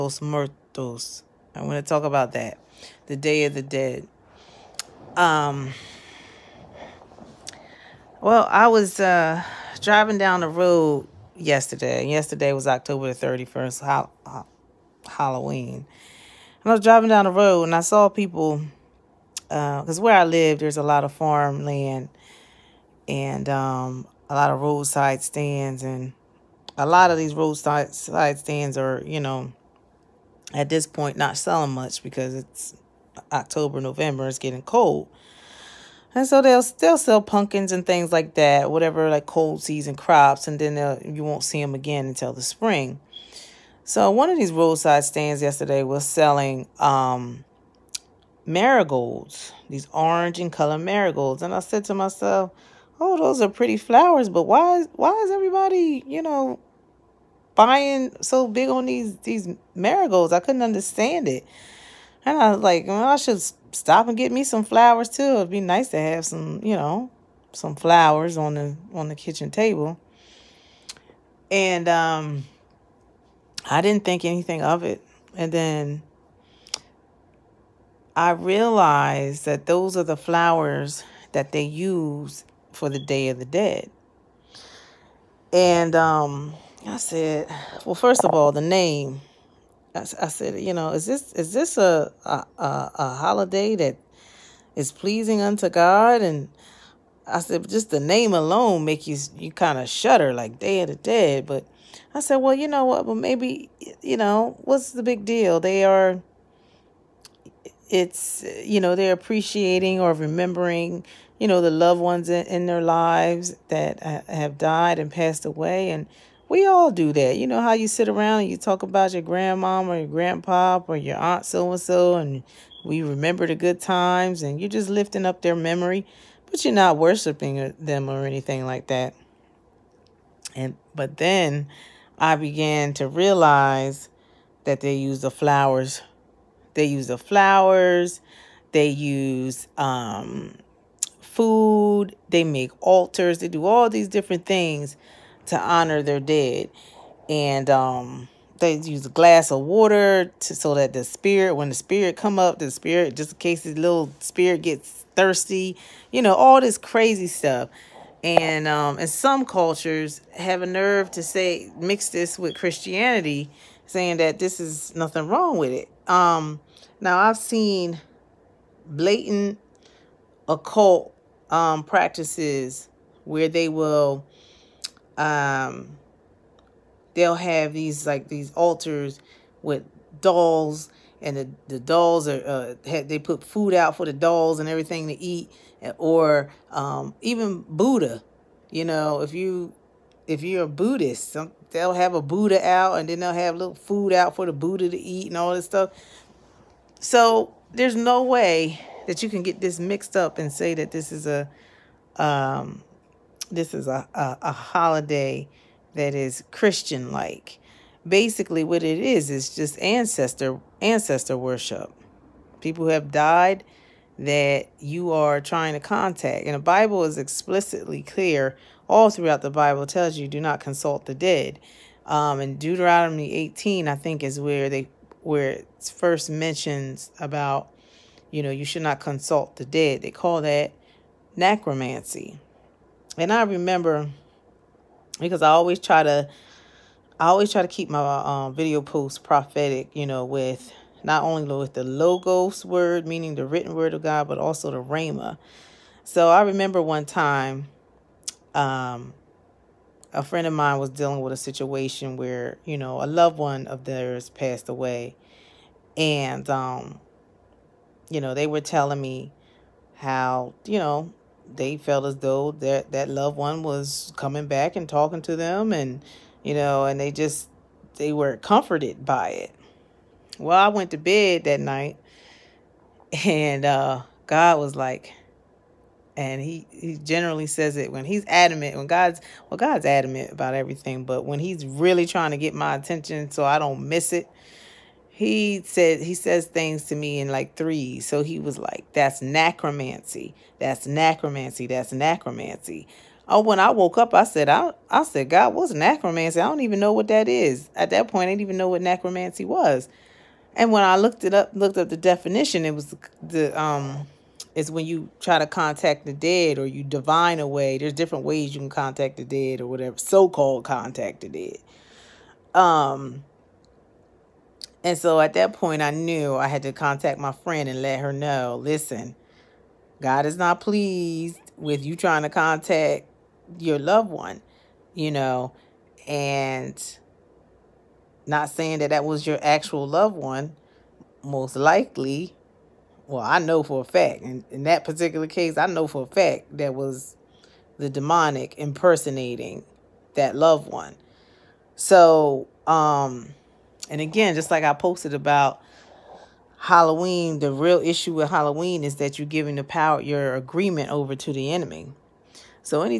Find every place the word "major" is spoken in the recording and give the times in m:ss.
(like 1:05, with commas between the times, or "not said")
not said.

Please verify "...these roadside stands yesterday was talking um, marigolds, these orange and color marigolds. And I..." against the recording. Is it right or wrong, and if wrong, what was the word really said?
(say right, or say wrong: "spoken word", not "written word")
wrong: "selling", not "talking".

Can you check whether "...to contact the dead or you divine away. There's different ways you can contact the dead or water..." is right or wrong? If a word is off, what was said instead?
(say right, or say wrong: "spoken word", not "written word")
wrong: "whatever", not "water".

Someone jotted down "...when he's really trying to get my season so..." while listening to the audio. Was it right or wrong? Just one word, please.
wrong.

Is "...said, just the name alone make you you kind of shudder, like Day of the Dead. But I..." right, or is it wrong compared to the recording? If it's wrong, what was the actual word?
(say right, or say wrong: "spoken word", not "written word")
right.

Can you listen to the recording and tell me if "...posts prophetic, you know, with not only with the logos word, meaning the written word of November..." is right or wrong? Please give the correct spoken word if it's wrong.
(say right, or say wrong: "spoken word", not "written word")
wrong: "God", not "November".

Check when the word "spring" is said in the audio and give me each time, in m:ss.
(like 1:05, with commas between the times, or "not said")
0:42.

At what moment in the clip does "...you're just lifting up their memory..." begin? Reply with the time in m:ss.
2:04.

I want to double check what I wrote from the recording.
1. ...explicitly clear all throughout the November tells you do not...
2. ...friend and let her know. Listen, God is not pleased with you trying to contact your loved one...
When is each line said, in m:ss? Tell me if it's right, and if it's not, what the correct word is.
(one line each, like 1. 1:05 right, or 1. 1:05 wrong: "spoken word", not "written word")
1. 3:37 wrong: "Bible", not "November"
2. 5:17 right.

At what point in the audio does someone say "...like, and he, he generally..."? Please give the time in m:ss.
4:34.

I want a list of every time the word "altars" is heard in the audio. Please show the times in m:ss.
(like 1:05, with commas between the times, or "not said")
2:22, 2:58.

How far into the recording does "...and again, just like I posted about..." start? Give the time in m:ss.
5:43.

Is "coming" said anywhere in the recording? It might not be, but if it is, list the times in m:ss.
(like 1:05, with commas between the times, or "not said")
4:24.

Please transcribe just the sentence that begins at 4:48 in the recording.
So he was like, "That's necromancy.